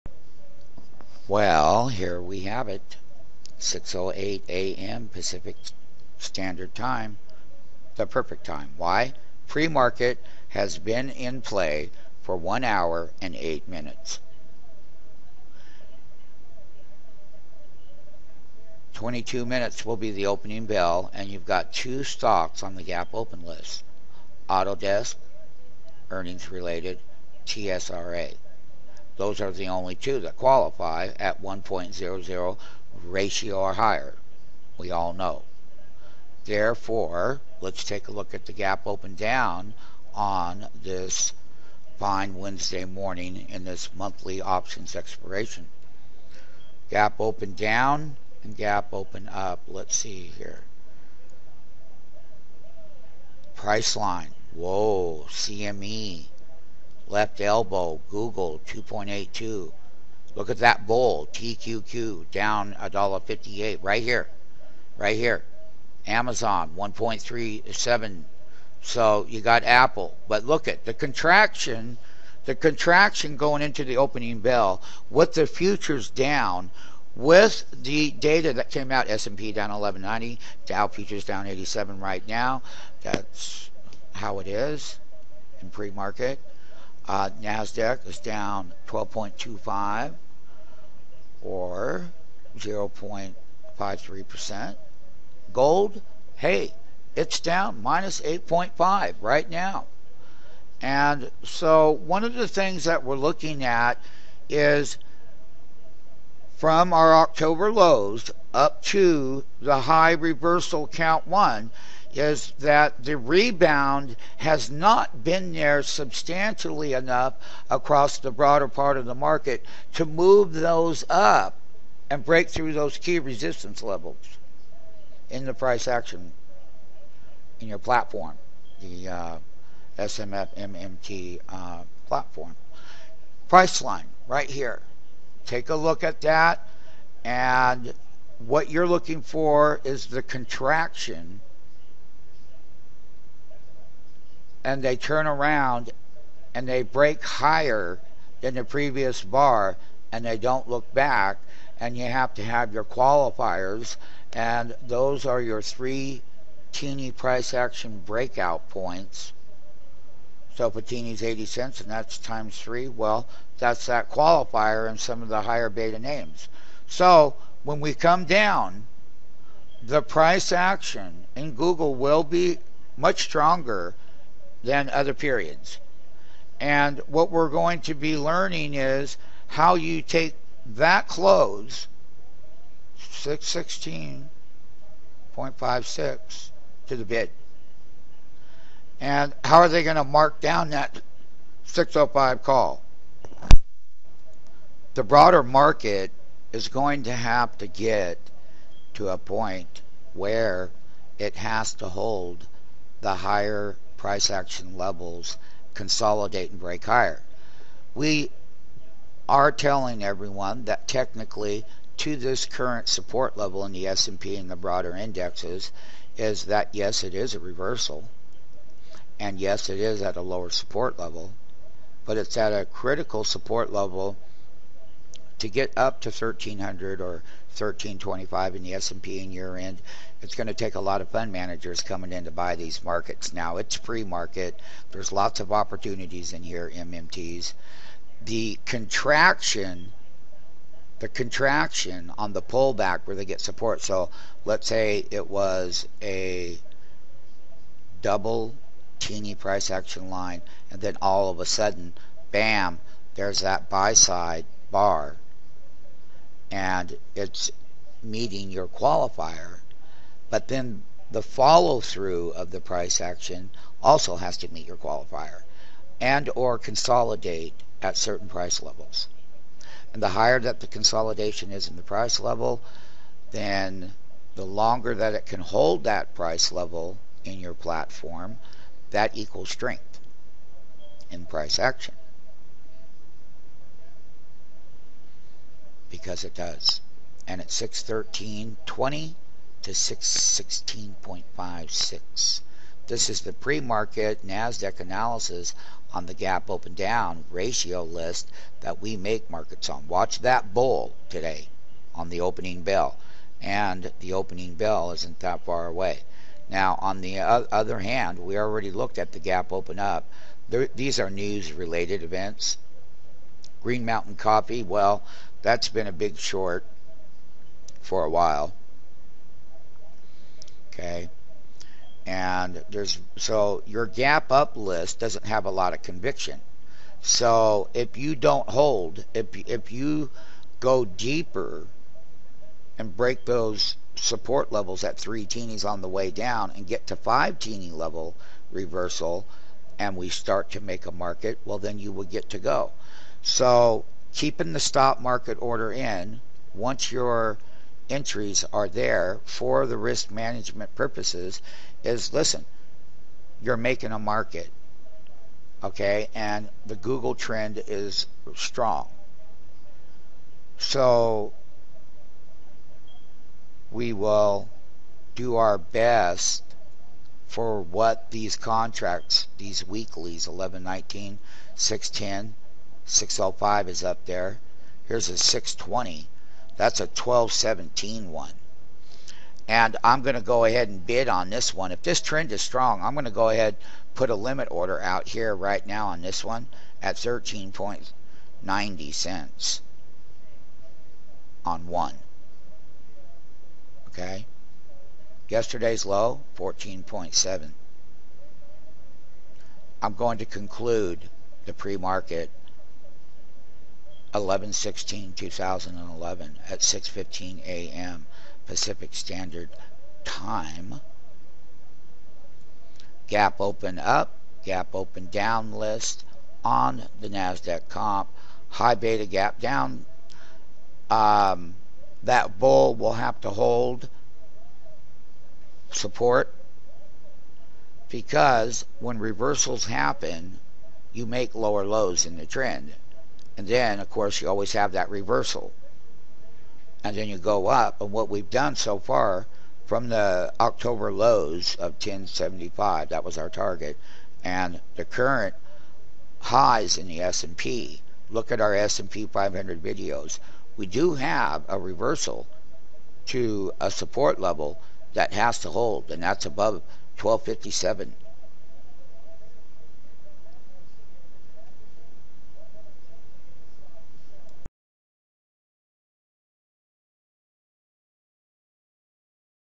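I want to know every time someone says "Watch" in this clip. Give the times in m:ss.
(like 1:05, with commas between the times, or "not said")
4:59.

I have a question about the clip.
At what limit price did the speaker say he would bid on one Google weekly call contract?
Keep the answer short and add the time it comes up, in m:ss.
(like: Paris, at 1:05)
13.90, at 6:26.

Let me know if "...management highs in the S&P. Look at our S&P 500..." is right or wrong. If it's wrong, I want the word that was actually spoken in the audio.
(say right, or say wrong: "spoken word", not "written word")
wrong: "current", not "management".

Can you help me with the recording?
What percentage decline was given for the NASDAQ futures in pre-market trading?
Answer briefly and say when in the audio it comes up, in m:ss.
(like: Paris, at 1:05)
0.53%, at 1:32.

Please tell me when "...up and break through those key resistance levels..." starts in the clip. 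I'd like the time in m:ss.
2:01.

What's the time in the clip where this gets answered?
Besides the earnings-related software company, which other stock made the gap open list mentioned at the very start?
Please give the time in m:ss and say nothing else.
0:27.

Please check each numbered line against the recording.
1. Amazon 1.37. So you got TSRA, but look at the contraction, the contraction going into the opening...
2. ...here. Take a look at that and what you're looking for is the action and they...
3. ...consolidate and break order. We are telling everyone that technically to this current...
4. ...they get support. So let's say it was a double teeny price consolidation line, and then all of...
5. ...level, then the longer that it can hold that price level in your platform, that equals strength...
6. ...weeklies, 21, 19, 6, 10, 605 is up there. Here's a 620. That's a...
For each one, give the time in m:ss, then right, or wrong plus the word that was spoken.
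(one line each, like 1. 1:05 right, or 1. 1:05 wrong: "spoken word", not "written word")
1. 1:06 wrong: "Apple", not "TSRA"
2. 2:14 wrong: "contraction", not "action"
3. 3:25 wrong: "higher", not "order"
4. 4:03 wrong: "action", not "consolidation"
5. 4:32 right
6. 6:09 wrong: "11", not "21".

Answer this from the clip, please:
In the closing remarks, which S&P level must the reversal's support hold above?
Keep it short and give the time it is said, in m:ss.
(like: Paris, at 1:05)
1257, at 7:36.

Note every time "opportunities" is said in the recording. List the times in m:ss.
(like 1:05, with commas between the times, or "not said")
3:55.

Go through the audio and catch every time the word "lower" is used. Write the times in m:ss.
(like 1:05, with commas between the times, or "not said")
3:40, 7:11.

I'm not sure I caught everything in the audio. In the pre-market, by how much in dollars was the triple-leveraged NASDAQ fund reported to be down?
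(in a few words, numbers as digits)
$1.58.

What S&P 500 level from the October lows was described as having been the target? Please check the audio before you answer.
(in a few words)
1075.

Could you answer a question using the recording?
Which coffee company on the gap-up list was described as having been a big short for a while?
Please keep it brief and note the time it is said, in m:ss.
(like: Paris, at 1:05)
Green Mountain Coffee, at 5:13.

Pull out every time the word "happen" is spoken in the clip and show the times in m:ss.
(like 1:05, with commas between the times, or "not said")
7:09.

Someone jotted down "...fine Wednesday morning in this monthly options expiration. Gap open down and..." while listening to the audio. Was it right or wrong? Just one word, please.
right.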